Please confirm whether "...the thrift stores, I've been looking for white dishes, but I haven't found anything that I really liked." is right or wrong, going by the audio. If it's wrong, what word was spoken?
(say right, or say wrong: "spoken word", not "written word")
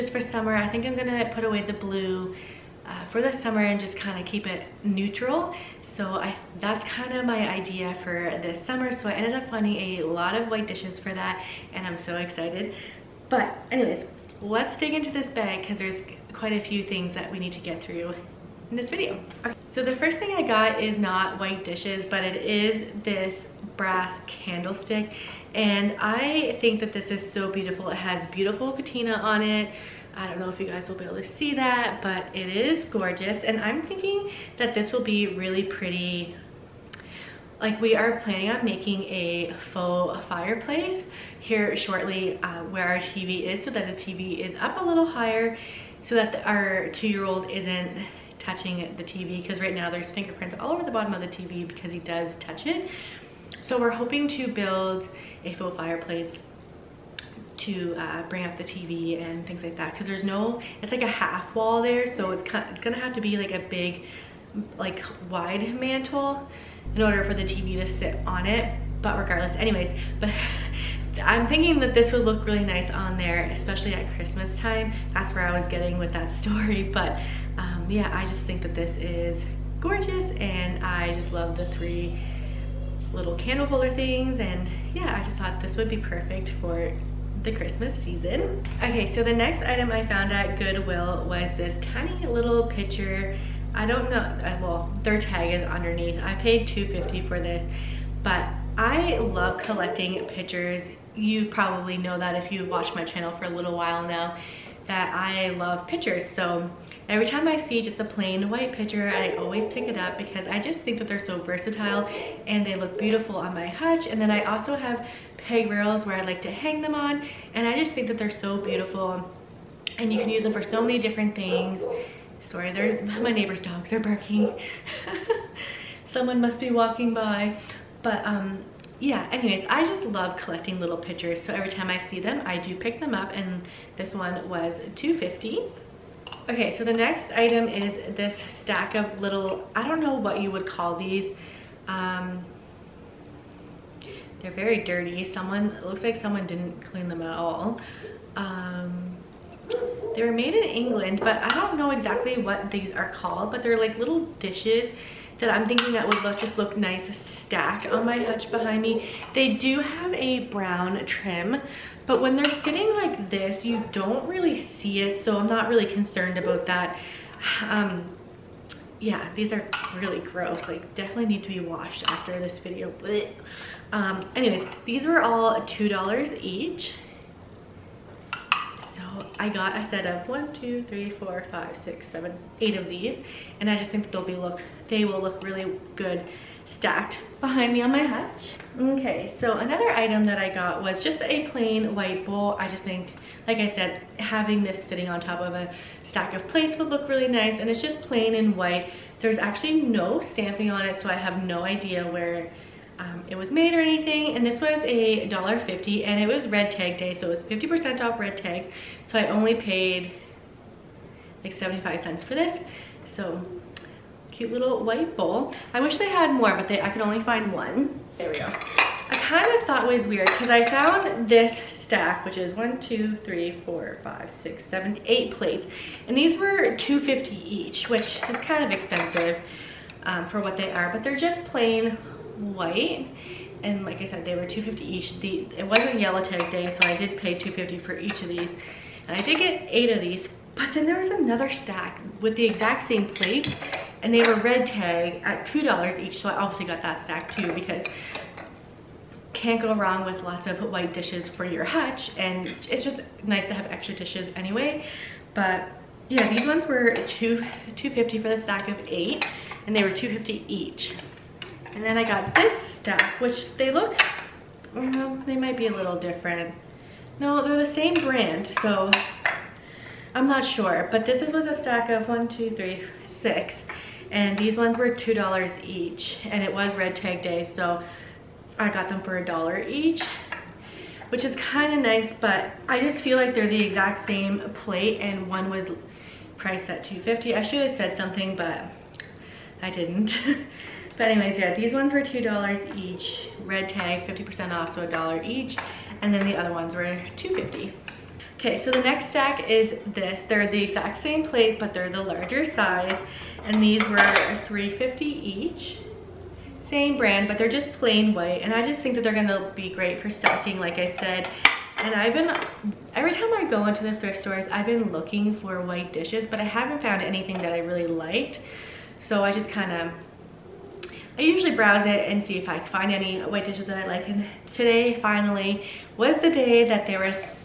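right.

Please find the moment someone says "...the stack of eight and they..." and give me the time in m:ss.
4:18.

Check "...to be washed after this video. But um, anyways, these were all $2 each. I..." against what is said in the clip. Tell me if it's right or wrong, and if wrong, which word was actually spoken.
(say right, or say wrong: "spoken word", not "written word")
right.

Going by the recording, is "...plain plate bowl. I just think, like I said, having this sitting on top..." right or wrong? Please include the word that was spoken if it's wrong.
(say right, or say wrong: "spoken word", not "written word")
wrong: "white", not "plate".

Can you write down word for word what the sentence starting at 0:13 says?
But anyways, let's dig into this bag because there's quite a few things that we need to get through in this video.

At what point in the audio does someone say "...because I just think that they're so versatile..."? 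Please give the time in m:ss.
1:50.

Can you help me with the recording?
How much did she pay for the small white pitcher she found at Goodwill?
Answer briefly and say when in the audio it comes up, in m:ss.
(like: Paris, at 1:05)
$2.50, at 1:36.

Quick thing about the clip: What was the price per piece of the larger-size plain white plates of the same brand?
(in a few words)
$3.50.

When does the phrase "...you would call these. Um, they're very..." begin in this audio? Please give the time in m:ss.
2:20.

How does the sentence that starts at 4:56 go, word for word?
And then the other ones were 2.50.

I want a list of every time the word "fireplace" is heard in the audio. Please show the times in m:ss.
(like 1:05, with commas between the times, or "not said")
0:40, 0:55.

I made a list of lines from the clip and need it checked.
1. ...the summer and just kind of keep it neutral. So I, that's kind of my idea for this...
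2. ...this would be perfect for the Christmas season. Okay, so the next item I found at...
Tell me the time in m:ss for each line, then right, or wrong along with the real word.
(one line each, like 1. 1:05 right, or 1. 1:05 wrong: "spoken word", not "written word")
1. 0:03 right
2. 1:25 right.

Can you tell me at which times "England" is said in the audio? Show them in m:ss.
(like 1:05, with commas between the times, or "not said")
2:30.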